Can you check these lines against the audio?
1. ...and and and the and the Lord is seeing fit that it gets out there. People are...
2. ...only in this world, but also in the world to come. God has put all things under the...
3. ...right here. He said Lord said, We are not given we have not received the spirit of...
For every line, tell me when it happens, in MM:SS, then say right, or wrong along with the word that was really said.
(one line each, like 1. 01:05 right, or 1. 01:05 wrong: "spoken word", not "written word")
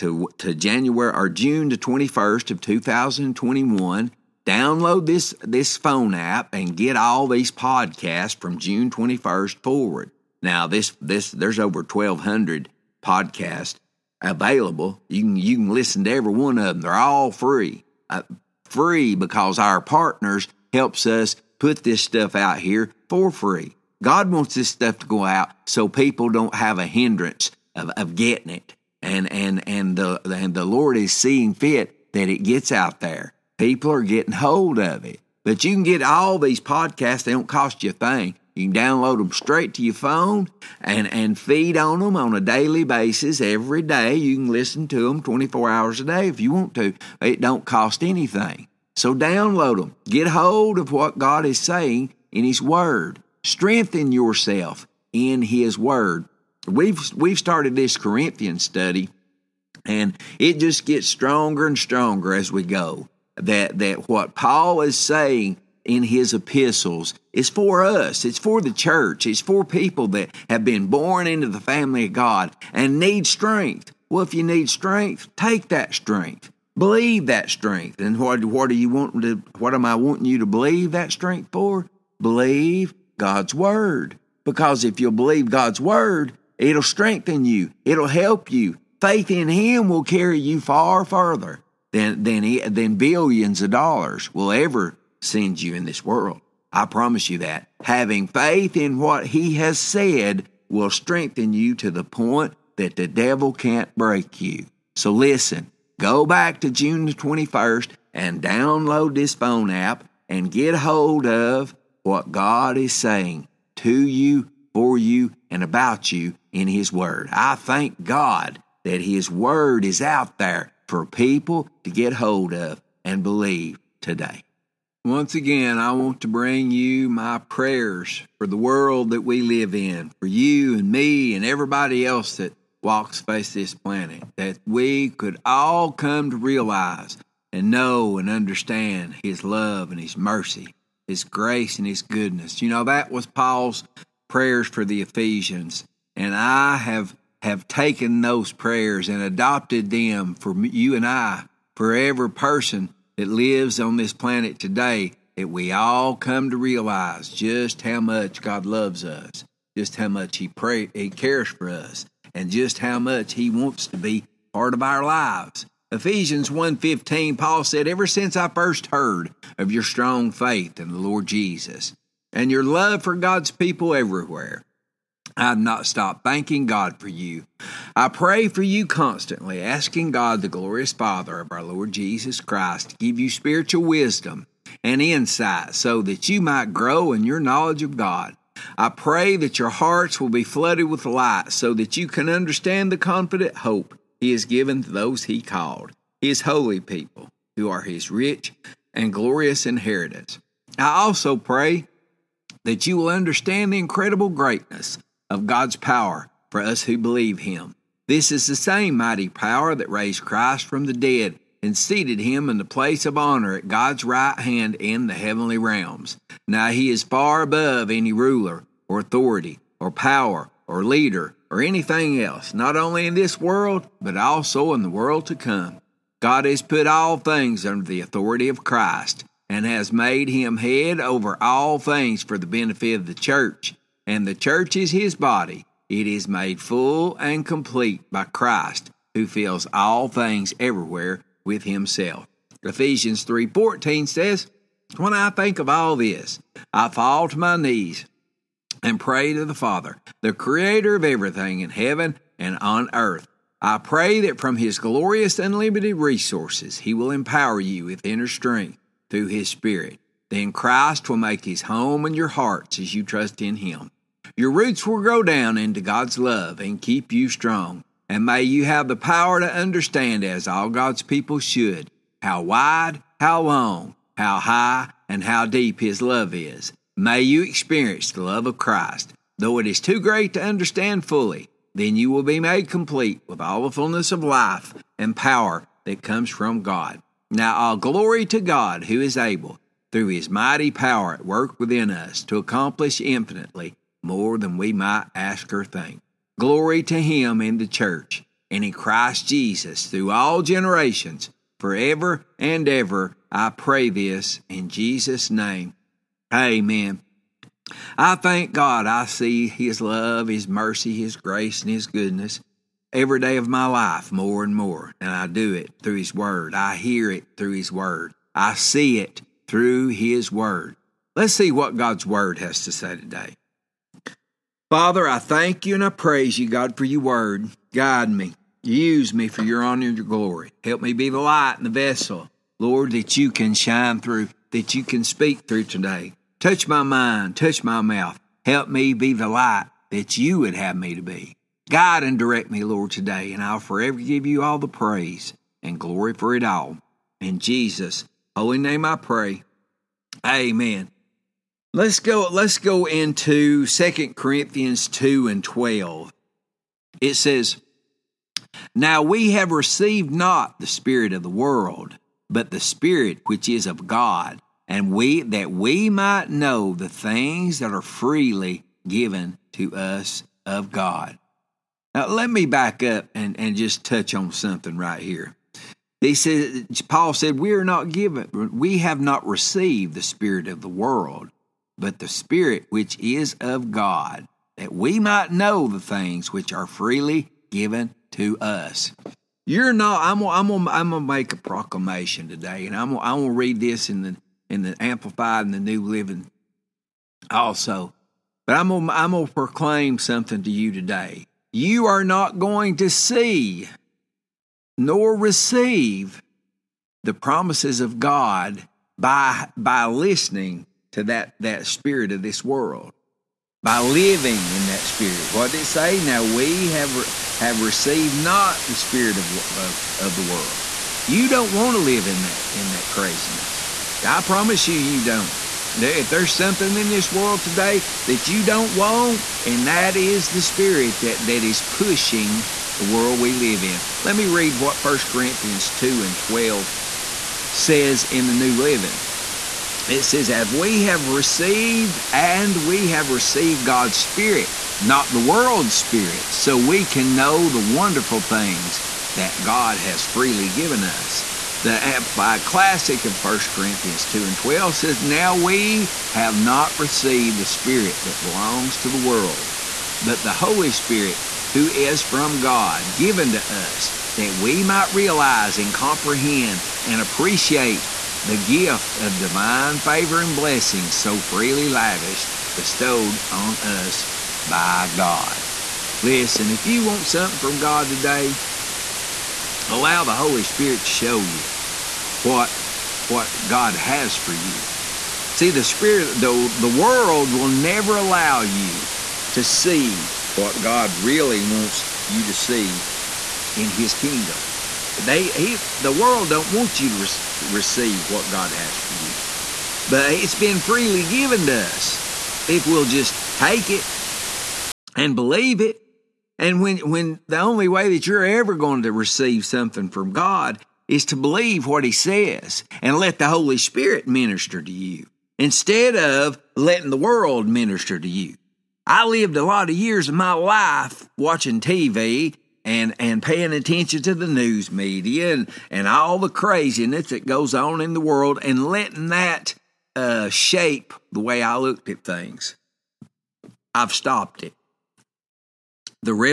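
1. 00:29 right
2. 03:42 right
3. 06:14 wrong: "Paul", not "Lord".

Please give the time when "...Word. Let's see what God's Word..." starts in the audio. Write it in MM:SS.
05:20.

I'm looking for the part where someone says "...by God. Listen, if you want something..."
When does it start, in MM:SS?
07:54.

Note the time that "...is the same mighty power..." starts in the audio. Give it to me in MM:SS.
03:28.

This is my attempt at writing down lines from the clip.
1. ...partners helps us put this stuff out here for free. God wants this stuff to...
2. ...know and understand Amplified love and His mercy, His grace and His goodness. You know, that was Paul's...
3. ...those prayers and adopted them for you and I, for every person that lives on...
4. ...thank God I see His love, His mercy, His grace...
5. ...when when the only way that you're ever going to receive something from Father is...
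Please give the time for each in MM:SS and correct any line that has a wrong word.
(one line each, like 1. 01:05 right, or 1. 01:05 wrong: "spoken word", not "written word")
1. 00:19 right
2. 02:17 wrong: "His", not "Amplified"
3. 02:28 right
4. 05:08 right
5. 08:26 wrong: "God", not "Father".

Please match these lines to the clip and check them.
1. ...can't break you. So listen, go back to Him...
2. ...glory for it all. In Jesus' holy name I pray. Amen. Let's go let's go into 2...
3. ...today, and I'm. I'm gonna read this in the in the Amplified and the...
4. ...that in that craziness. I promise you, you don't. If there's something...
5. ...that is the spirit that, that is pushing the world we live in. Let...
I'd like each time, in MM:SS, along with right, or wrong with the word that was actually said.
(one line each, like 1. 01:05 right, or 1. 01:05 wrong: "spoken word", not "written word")
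1. 01:43 wrong: "June", not "Him"
2. 05:45 right
3. 06:32 right
4. 07:02 right
5. 07:09 right.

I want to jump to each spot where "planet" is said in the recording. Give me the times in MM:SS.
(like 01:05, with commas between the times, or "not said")
02:13, 02:34.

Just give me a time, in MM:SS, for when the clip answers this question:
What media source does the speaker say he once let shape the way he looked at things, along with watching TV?
08:44.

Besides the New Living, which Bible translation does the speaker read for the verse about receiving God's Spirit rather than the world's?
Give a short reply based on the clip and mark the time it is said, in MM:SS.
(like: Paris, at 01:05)
Amplified Classic, at 07:31.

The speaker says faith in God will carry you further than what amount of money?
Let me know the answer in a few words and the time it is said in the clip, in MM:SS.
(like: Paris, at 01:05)
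billions of dollars, at 01:32.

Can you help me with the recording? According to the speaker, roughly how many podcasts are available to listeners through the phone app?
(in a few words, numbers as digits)
over 1200.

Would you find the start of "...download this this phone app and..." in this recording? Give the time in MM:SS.
00:04.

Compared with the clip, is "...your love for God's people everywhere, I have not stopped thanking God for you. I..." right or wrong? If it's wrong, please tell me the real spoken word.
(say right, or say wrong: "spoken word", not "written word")
right.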